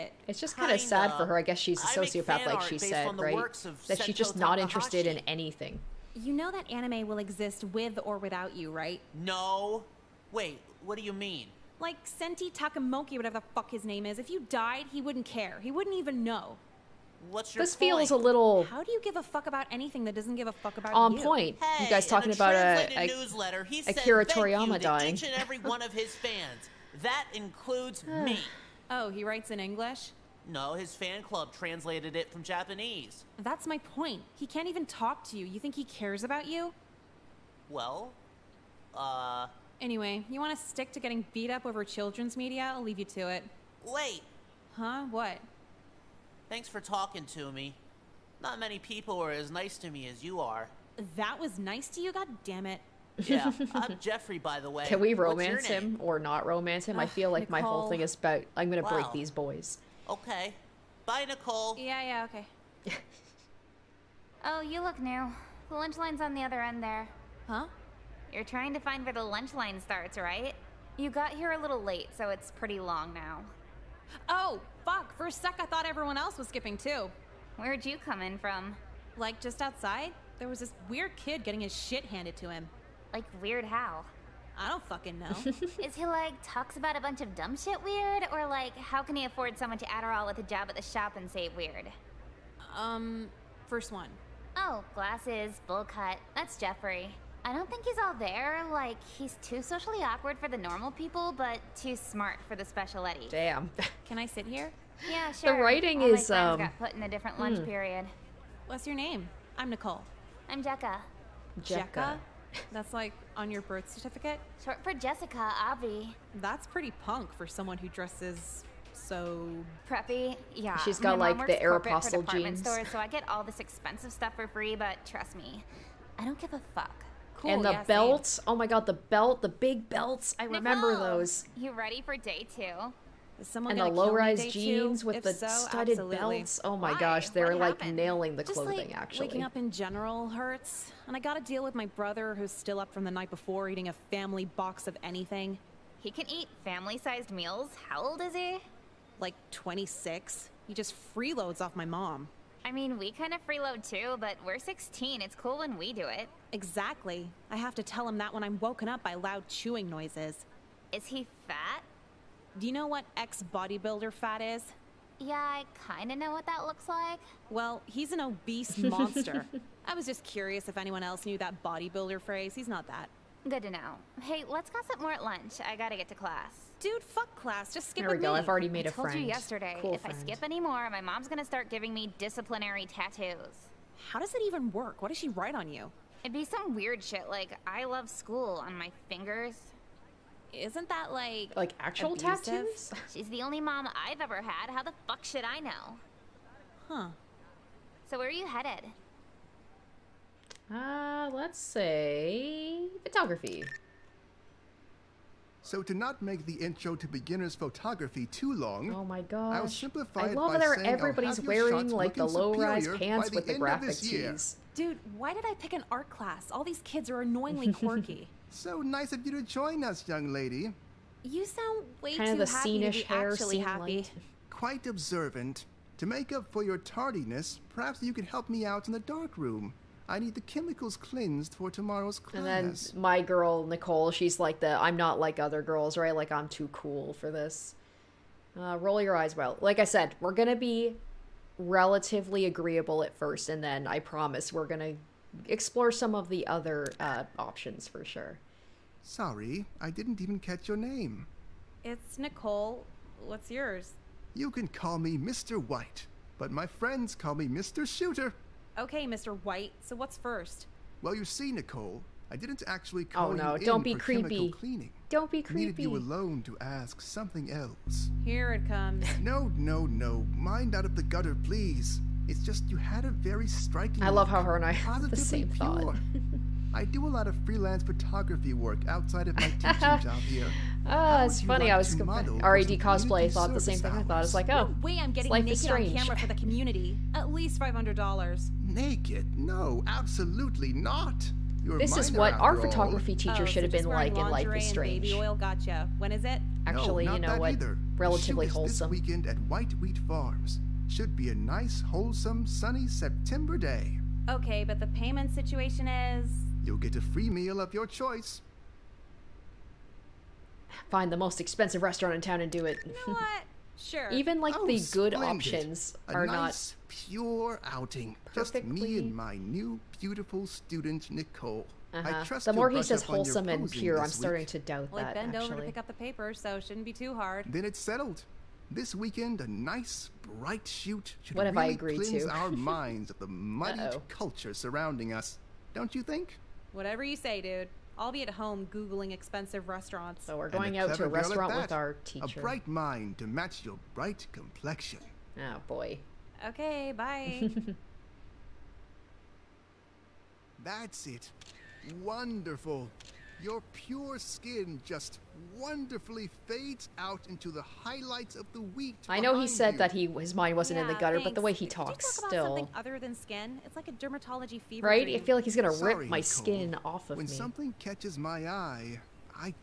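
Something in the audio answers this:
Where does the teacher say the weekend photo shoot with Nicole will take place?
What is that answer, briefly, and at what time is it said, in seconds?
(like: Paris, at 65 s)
White Wheat Farms, at 299 s.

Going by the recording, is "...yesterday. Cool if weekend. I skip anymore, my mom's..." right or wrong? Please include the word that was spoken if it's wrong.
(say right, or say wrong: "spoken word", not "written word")
wrong: "friend", not "weekend".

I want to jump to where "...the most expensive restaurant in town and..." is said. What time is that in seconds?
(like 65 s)
311 s.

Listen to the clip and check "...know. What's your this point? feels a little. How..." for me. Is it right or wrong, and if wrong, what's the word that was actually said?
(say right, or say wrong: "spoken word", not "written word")
right.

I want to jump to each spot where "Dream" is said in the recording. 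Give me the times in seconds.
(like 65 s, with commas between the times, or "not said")
365 s.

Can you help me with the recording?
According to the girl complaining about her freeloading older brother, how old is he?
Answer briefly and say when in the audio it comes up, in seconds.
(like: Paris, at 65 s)
26, at 149 s.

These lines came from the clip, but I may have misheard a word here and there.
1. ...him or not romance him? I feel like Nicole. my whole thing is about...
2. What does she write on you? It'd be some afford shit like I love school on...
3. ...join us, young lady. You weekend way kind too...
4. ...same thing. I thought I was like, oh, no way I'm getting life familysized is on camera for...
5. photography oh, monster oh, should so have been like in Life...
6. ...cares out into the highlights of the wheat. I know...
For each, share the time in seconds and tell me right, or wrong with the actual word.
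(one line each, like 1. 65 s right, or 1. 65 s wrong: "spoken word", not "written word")
1. 55 s right
2. 184 s wrong: "weird", not "afford"
3. 219 s wrong: "sound", not "weekend"
4. 283 s wrong: "naked", not "familysized"
5. 292 s wrong: "teacher", not "monster"
6. 356 s wrong: "fades", not "cares".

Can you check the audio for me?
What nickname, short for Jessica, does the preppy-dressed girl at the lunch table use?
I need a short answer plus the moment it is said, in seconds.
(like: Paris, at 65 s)
Jecka, at 110 s.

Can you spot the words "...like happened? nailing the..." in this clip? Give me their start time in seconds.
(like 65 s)
137 s.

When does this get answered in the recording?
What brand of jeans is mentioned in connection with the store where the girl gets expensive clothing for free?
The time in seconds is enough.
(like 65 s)
121 s.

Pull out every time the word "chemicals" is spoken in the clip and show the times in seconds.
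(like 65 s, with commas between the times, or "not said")
230 s, 264 s.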